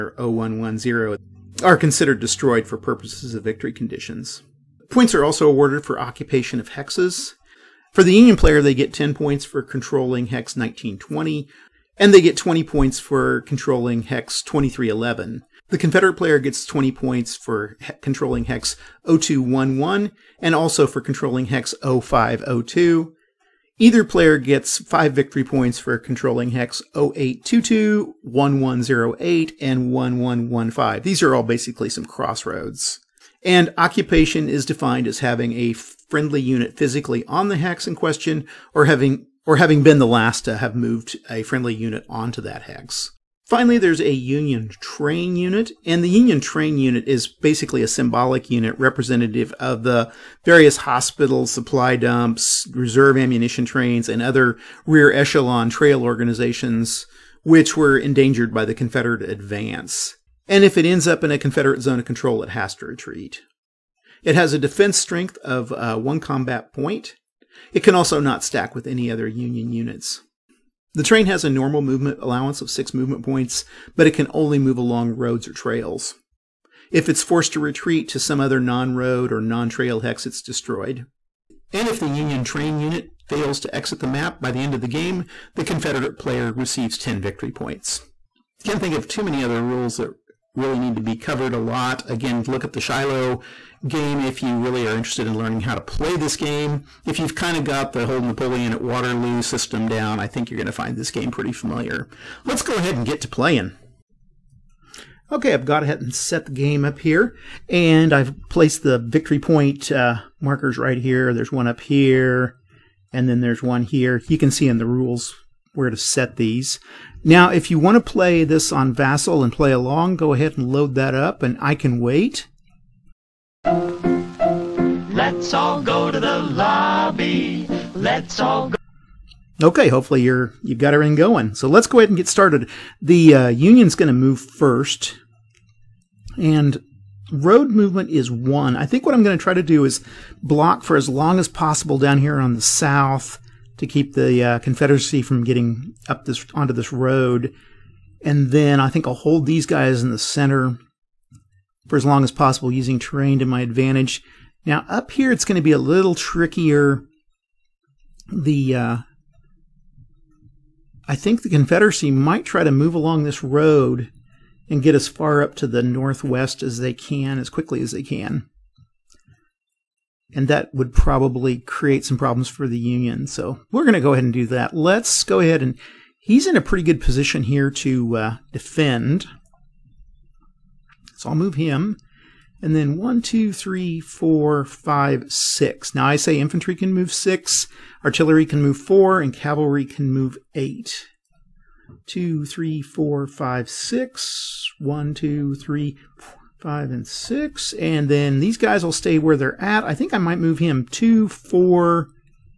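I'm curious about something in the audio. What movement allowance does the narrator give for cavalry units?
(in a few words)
8.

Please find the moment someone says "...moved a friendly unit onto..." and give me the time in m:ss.
0:40.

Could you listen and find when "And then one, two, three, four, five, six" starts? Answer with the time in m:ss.
3:02.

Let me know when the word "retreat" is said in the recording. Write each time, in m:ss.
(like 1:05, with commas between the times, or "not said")
1:02, 1:17.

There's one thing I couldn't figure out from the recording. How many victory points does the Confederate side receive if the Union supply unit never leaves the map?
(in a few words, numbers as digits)
10.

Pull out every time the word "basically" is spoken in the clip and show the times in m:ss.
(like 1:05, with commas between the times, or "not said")
0:31, 0:47.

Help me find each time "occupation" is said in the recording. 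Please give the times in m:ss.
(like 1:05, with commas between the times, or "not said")
0:05, 0:33.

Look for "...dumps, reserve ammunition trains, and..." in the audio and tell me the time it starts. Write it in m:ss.
0:51.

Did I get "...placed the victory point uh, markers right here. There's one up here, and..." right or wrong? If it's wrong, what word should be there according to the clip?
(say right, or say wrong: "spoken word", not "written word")
right.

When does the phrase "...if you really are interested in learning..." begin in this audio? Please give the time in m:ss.
1:34.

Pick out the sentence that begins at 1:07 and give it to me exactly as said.
It can also not stack with any other Union units.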